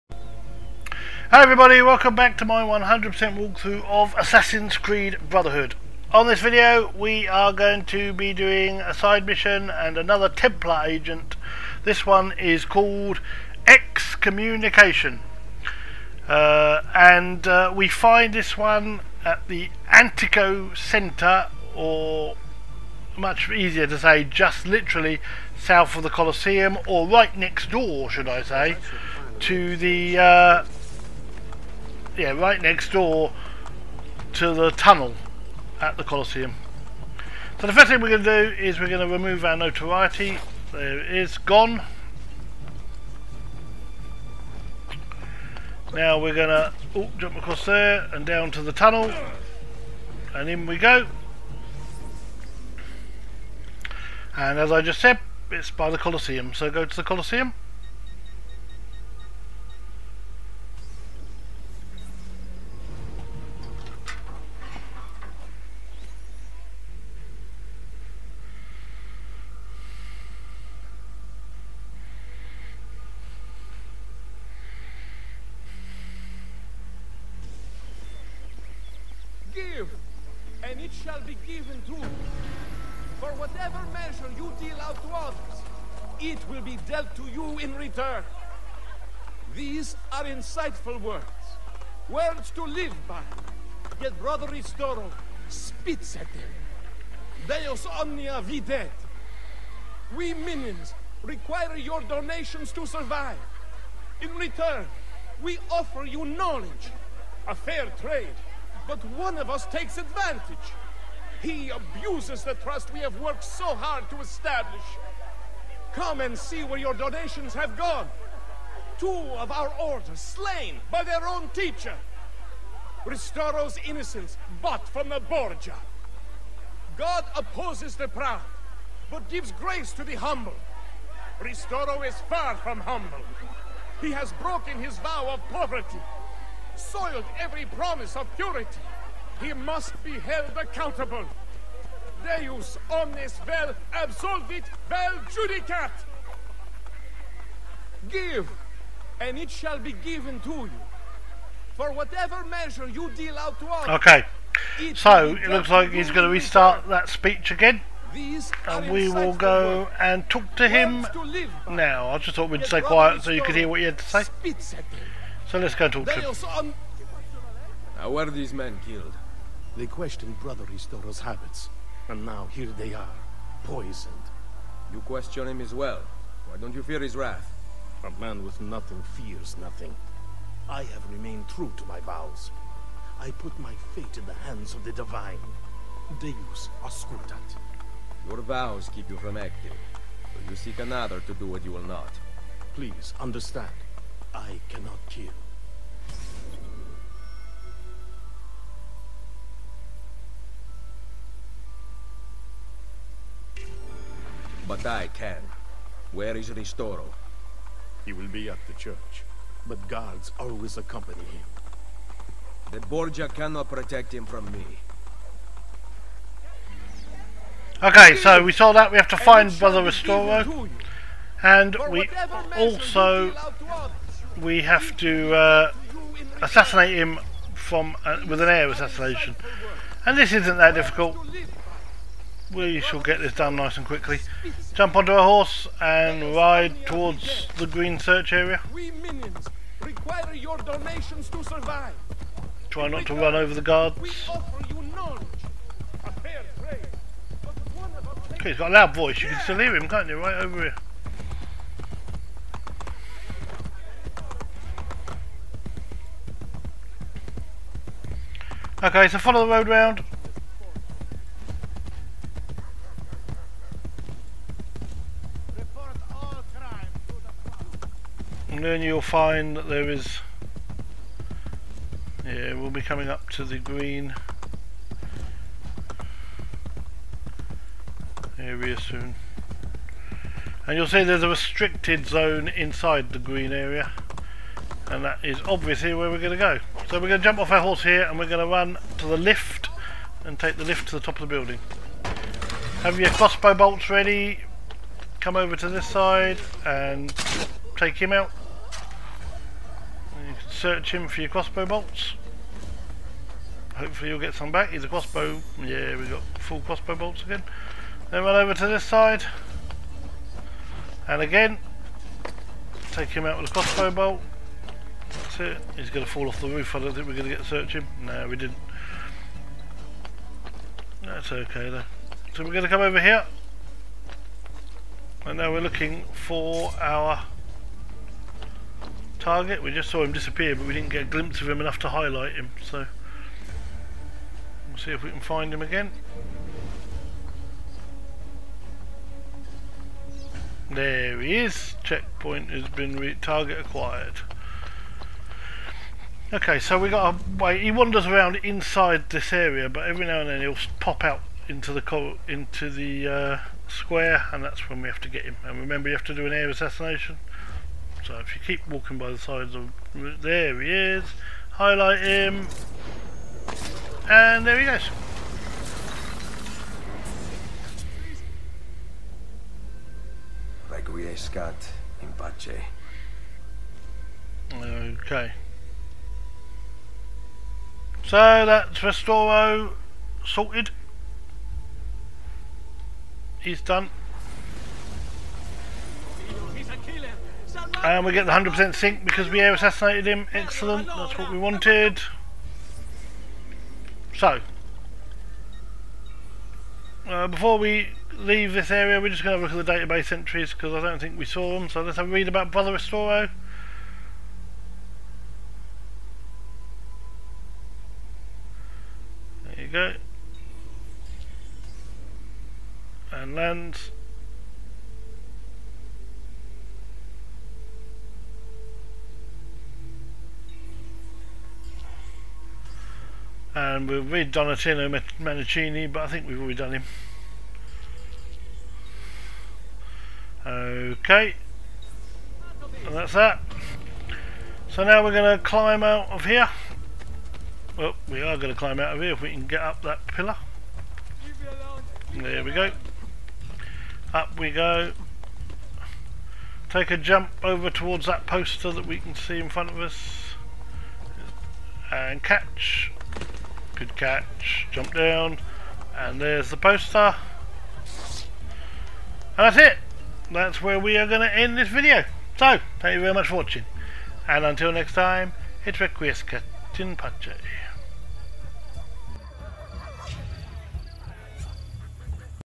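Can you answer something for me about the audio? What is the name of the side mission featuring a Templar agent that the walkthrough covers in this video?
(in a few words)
Excommunication.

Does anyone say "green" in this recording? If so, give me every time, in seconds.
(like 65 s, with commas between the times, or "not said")
237 s, 273 s, 283 s.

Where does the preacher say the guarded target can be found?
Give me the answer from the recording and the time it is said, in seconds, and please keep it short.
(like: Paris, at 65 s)
At the church, at 208 s.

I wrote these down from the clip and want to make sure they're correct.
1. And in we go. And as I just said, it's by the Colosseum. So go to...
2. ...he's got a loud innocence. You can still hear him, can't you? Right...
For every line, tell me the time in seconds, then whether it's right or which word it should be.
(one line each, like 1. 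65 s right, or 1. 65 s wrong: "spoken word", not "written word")
1. 50 s right
2. 248 s wrong: "voice", not "innocence".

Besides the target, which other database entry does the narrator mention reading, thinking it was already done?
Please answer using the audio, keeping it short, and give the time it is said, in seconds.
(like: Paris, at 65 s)
Donatino Mancini, at 424 s.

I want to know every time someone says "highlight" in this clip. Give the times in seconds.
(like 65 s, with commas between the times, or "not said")
331 s, 361 s.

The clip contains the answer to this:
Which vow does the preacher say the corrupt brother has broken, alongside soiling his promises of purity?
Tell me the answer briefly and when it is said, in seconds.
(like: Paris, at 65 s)
Poverty, at 134 s.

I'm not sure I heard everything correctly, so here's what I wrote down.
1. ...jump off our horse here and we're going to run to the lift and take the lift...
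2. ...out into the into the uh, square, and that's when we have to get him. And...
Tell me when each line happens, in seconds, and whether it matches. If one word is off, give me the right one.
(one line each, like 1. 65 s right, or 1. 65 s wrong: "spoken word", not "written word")
1. 287 s right
2. 351 s right.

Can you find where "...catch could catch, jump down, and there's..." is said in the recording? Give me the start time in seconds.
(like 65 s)
452 s.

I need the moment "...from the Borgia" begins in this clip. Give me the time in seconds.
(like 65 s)
124 s.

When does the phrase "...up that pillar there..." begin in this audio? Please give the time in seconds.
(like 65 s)
439 s.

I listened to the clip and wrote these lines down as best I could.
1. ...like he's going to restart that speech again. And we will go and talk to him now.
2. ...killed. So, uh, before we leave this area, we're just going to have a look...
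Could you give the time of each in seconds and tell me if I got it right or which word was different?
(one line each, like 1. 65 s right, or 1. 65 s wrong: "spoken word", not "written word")
1. 155 s right
2. 391 s wrong: "wanted", not "killed".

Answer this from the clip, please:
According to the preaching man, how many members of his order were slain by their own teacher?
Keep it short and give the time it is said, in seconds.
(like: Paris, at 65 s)
2, at 118 s.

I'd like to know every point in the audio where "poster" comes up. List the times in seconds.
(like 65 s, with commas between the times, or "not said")
448 s, 456 s.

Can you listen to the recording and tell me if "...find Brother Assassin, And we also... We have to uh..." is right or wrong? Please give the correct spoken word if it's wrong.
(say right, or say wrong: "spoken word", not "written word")
wrong: "Ristoro", not "Assassin".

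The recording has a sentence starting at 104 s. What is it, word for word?
In return, we offer you knowledge, a fair trade, but one of us takes advantage.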